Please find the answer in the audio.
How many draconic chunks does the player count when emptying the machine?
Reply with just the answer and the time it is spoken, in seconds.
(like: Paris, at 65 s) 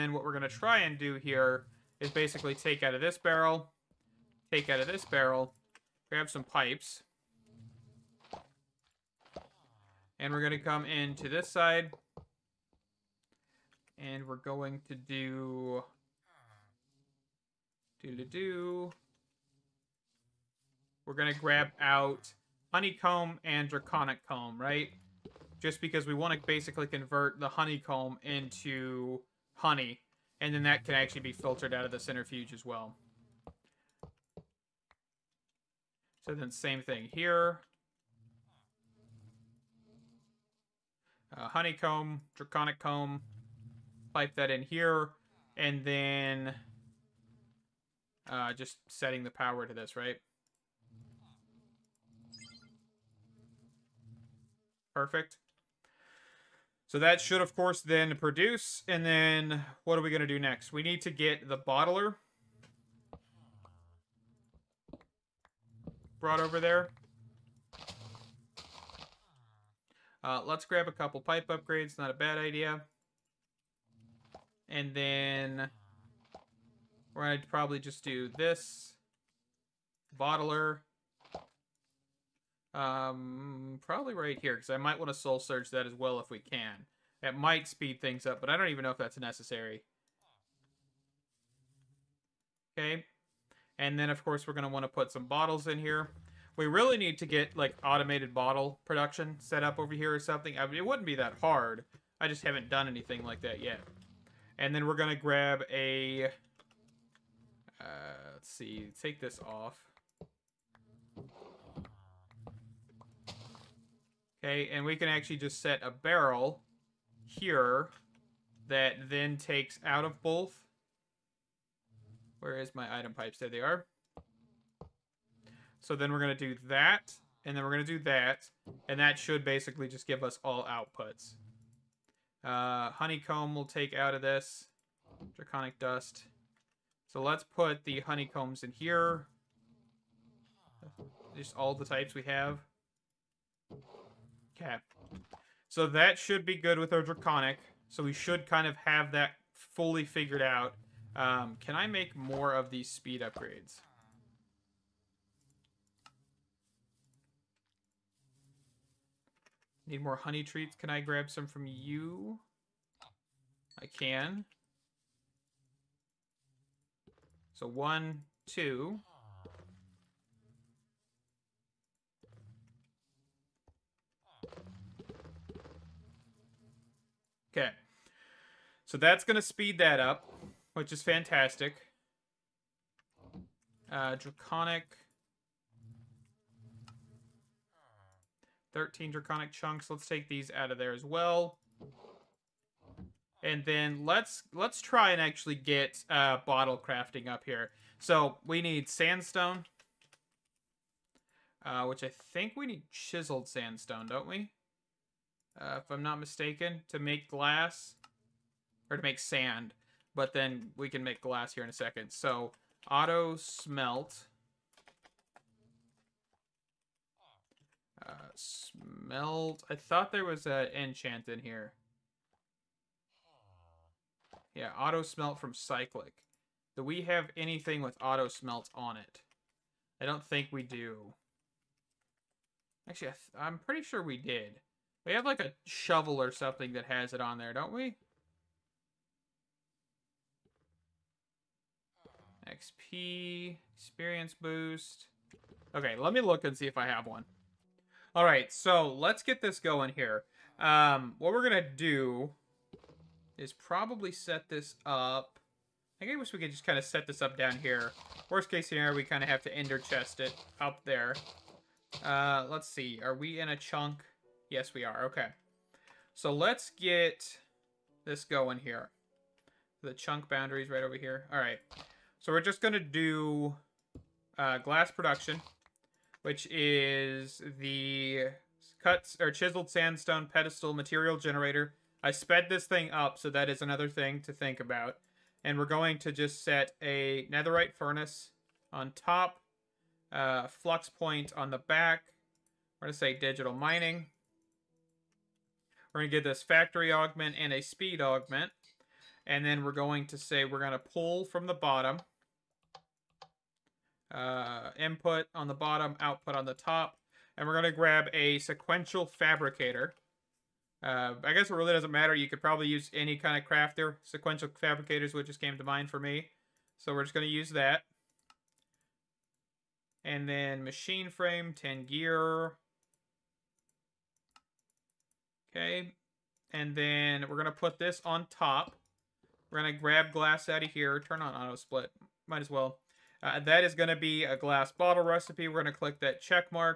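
13, at 188 s.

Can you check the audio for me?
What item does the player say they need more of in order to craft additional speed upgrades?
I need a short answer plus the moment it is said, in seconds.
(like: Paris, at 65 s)
honey treats, at 160 s.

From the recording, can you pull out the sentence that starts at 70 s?
Uh, let's grab a couple pipe upgrades.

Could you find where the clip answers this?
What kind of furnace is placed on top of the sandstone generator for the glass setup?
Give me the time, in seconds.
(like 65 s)
287 s.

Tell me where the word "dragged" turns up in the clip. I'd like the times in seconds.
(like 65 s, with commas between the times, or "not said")
not said.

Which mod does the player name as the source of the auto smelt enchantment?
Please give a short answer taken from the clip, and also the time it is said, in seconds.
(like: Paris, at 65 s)
cyclic, at 225 s.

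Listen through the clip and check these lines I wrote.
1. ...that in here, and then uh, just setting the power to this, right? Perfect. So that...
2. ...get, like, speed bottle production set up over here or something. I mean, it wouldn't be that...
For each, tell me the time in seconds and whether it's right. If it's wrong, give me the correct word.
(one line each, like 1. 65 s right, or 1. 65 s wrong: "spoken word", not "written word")
1. 44 s right
2. 97 s wrong: "automated", not "speed".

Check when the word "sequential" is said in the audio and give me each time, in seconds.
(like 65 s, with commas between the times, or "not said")
308 s, 314 s.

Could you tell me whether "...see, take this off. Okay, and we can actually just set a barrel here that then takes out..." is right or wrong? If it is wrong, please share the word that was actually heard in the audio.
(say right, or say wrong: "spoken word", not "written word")
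right.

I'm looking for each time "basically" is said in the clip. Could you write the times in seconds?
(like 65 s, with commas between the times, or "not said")
2 s, 26 s, 129 s.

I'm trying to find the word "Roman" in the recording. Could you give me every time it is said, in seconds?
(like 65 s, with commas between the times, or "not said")
not said.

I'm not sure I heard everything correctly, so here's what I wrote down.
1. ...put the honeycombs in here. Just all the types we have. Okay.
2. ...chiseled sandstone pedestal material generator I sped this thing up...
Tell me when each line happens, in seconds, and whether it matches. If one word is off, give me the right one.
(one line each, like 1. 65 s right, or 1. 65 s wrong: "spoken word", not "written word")
1. 137 s right
2. 279 s right.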